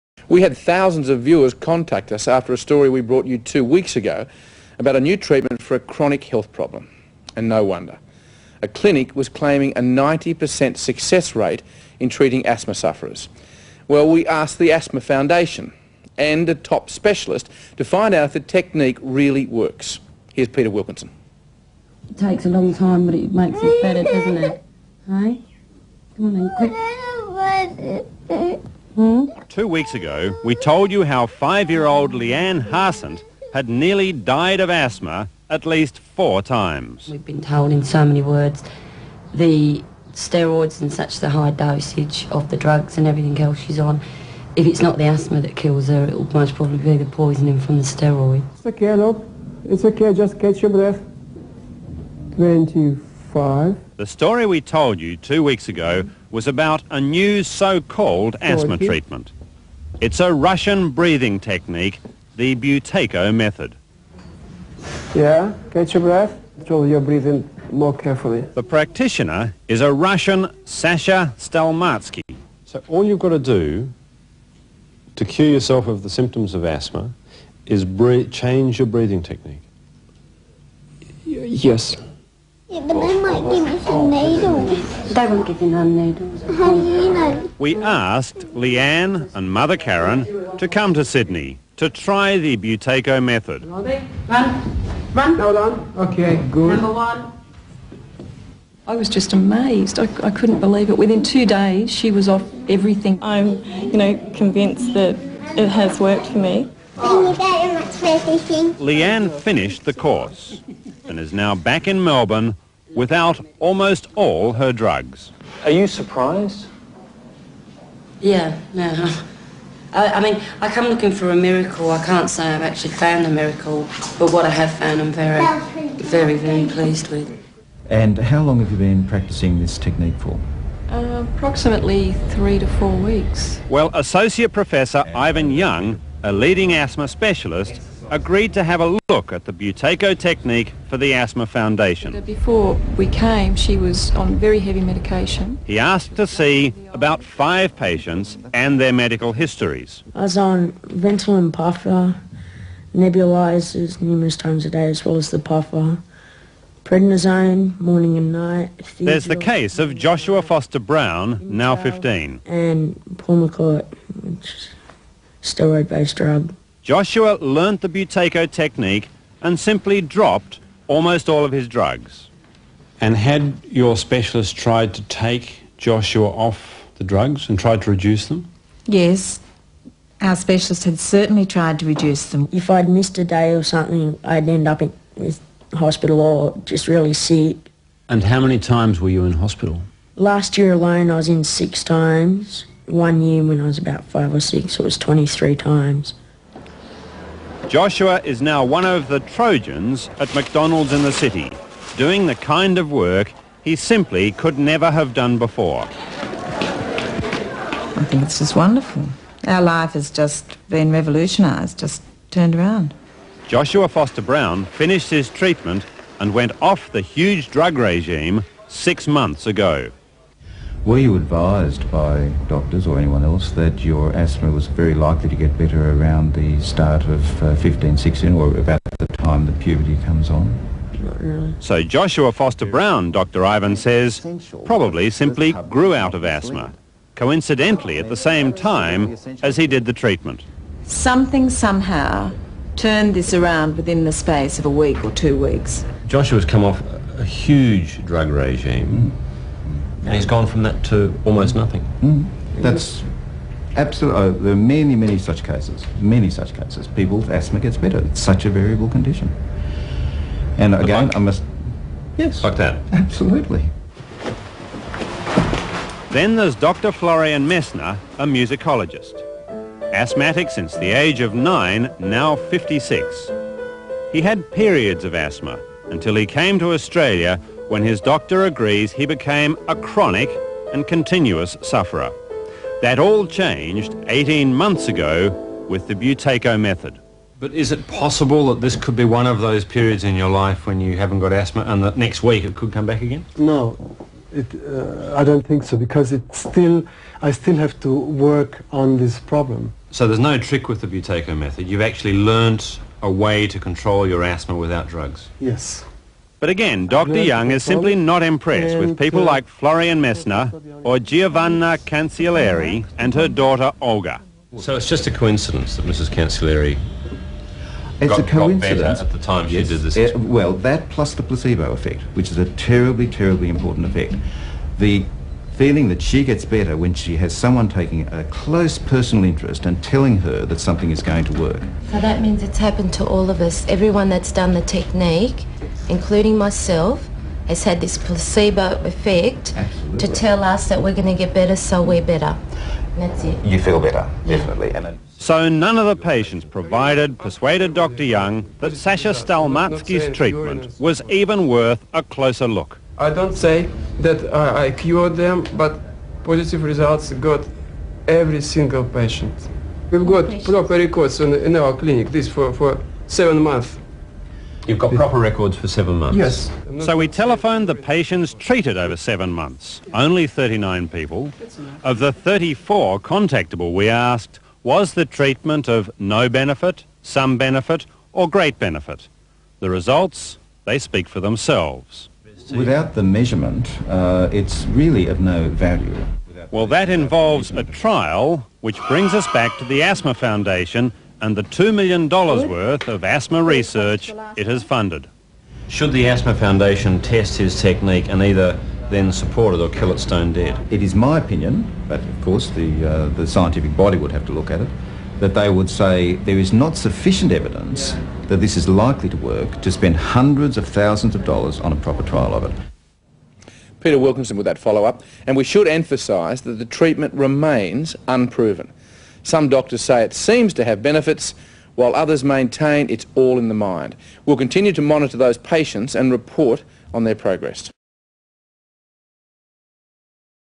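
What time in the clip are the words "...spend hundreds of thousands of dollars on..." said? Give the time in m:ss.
6:49.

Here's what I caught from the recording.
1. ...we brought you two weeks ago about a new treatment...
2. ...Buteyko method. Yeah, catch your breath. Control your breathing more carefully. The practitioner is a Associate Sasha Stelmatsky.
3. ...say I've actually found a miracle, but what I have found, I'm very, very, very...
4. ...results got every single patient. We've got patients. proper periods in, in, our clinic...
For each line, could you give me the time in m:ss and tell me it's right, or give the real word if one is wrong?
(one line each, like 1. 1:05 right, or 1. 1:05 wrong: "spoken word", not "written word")
1. 0:02 right
2. 1:02 wrong: "Russian", not "Associate"
3. 2:02 right
4. 5:56 wrong: "records", not "periods".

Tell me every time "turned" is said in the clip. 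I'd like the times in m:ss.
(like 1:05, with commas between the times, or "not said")
3:32, 4:02.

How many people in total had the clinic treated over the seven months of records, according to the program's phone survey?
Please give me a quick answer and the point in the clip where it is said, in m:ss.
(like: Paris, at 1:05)
39, at 6:10.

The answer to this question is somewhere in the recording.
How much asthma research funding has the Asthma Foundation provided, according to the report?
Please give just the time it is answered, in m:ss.
6:31.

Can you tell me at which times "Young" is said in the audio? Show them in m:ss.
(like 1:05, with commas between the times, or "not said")
2:15, 5:07, 5:48.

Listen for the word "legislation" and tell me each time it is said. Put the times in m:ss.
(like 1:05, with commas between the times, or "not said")
not said.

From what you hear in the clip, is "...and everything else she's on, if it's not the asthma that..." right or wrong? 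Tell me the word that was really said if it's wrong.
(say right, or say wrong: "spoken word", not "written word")
right.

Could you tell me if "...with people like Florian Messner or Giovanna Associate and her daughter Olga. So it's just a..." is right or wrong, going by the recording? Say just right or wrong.
wrong.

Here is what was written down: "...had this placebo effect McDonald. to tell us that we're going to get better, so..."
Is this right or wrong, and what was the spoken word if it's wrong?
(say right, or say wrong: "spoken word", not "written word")
wrong: "Absolutely", not "McDonald".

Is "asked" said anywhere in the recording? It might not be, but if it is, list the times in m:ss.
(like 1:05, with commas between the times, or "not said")
0:14, 1:27, 2:25, 6:13.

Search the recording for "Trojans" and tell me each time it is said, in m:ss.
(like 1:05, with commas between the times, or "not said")
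3:19.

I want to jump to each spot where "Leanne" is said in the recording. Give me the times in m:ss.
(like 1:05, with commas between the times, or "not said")
0:32, 1:28, 1:46.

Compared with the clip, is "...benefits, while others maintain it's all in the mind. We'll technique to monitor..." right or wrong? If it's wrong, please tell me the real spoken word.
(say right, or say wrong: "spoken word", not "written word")
wrong: "continue", not "technique".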